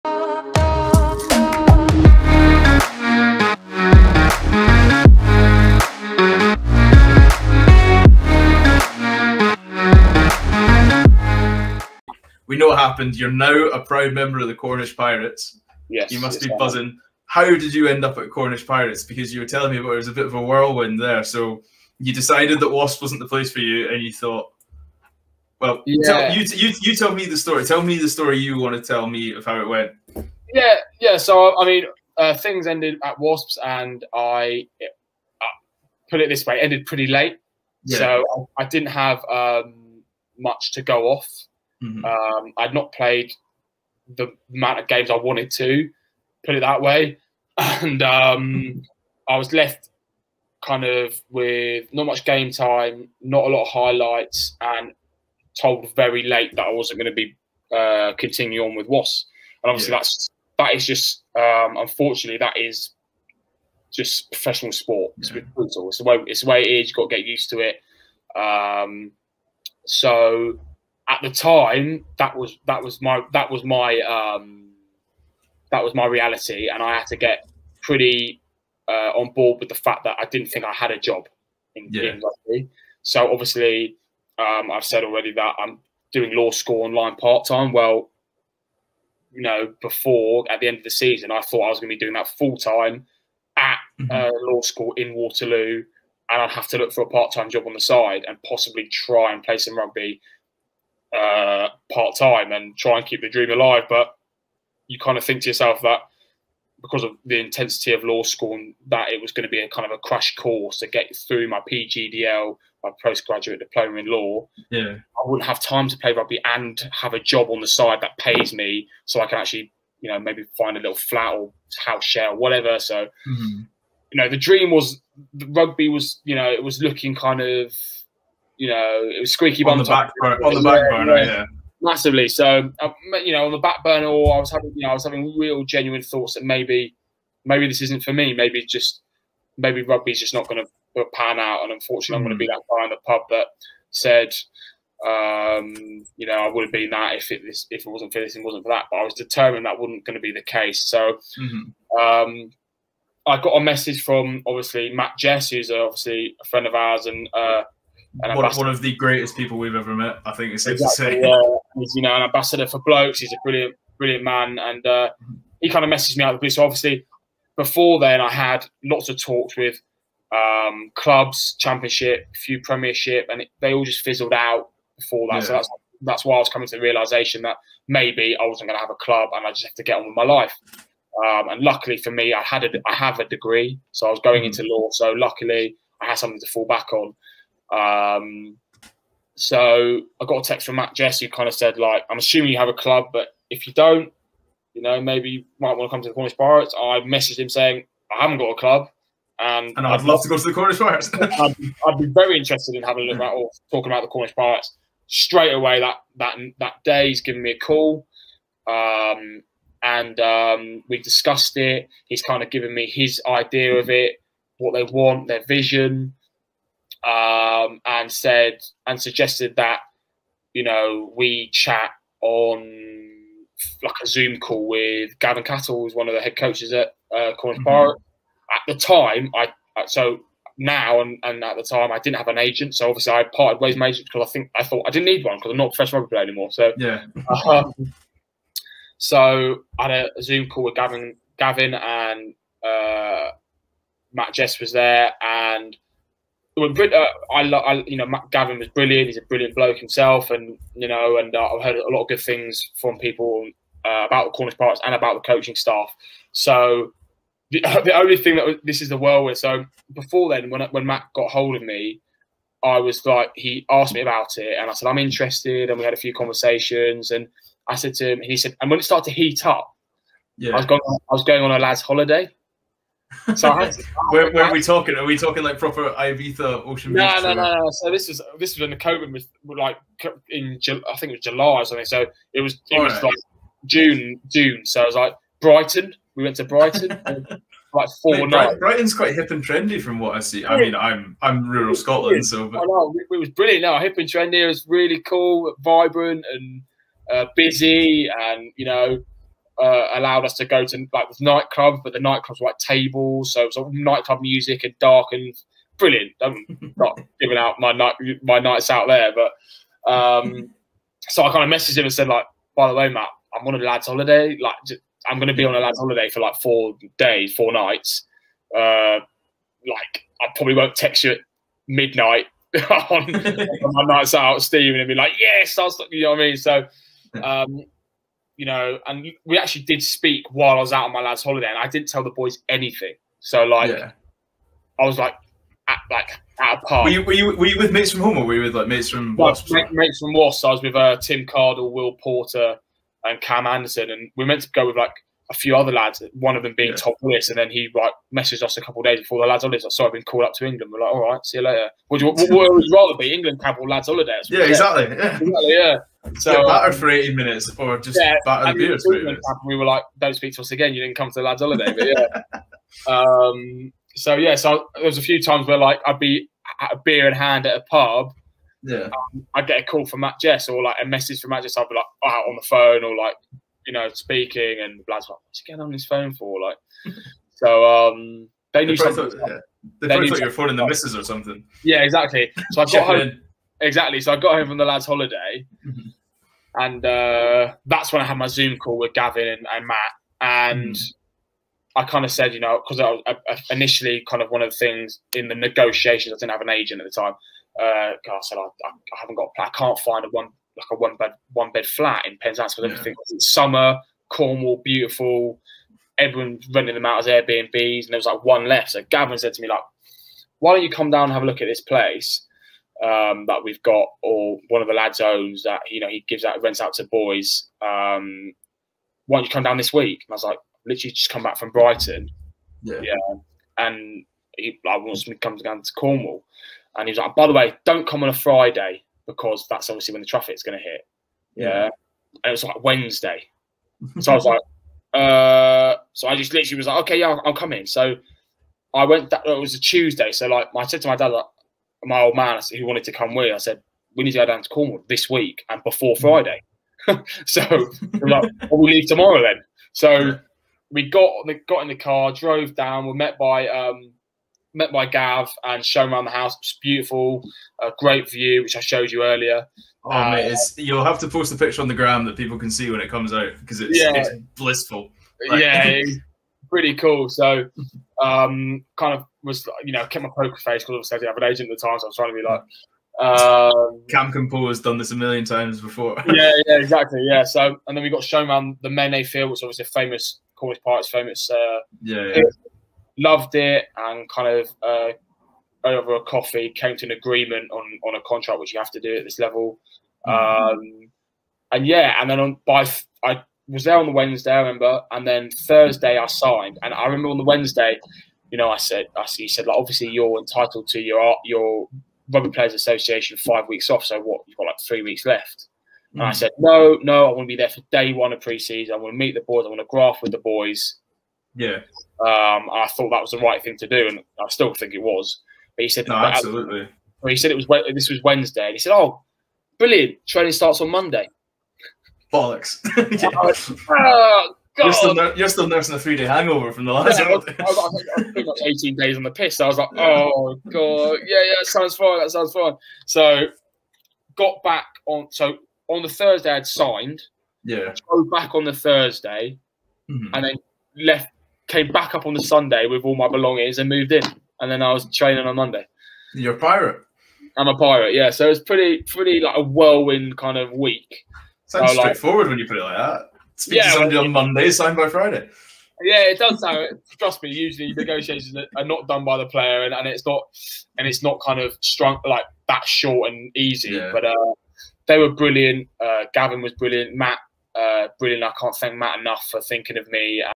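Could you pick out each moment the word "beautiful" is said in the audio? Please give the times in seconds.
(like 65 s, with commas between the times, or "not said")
404 s, 456 s.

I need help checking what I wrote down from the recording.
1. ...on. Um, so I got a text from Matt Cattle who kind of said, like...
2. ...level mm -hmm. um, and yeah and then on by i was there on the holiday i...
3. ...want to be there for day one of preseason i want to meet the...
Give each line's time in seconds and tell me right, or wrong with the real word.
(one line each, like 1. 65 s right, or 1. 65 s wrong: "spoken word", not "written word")
1. 186 s wrong: "Jess", not "Cattle"
2. 489 s wrong: "wednesday", not "holiday"
3. 507 s right.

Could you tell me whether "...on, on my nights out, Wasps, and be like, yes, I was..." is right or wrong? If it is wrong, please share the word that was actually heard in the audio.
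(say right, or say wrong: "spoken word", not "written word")
wrong: "Steven", not "Wasps".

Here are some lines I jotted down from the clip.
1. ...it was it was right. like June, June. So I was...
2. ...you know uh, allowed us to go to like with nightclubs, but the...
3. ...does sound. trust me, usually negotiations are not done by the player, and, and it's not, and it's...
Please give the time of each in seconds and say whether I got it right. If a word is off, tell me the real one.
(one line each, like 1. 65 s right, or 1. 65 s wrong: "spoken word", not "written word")
1. 282 s right
2. 298 s right
3. 556 s right.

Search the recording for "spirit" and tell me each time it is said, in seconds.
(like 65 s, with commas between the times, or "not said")
not said.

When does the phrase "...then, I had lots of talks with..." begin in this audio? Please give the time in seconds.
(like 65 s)
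167 s.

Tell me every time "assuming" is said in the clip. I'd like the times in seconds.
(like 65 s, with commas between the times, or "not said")
192 s.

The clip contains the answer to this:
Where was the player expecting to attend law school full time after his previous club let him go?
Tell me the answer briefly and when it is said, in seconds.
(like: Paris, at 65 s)
Waterloo, at 95 s.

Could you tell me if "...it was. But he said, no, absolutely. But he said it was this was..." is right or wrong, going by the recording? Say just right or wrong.
right.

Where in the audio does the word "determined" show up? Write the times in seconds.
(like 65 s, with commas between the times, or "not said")
149 s.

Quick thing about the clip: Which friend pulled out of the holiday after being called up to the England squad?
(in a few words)
Tom Willis.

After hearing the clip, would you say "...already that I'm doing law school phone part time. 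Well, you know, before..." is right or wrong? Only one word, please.
wrong.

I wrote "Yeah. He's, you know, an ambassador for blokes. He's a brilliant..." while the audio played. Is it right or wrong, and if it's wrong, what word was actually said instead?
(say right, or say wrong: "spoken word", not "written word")
right.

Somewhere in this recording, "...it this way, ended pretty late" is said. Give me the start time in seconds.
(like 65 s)
36 s.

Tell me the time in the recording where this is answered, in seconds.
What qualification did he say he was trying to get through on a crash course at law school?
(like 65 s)
111 s.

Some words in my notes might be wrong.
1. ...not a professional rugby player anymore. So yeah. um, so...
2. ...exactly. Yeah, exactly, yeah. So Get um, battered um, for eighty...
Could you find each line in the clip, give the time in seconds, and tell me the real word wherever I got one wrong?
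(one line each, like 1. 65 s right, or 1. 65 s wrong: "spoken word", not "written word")
1. 235 s right
2. 354 s right.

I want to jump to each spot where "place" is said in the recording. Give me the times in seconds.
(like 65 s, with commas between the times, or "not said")
23 s, 411 s.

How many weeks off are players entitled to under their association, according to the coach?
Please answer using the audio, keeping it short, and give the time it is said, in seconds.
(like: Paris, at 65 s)
5, at 503 s.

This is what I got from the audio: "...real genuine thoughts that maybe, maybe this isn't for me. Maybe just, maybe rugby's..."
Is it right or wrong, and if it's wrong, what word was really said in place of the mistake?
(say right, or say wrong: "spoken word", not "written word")
right.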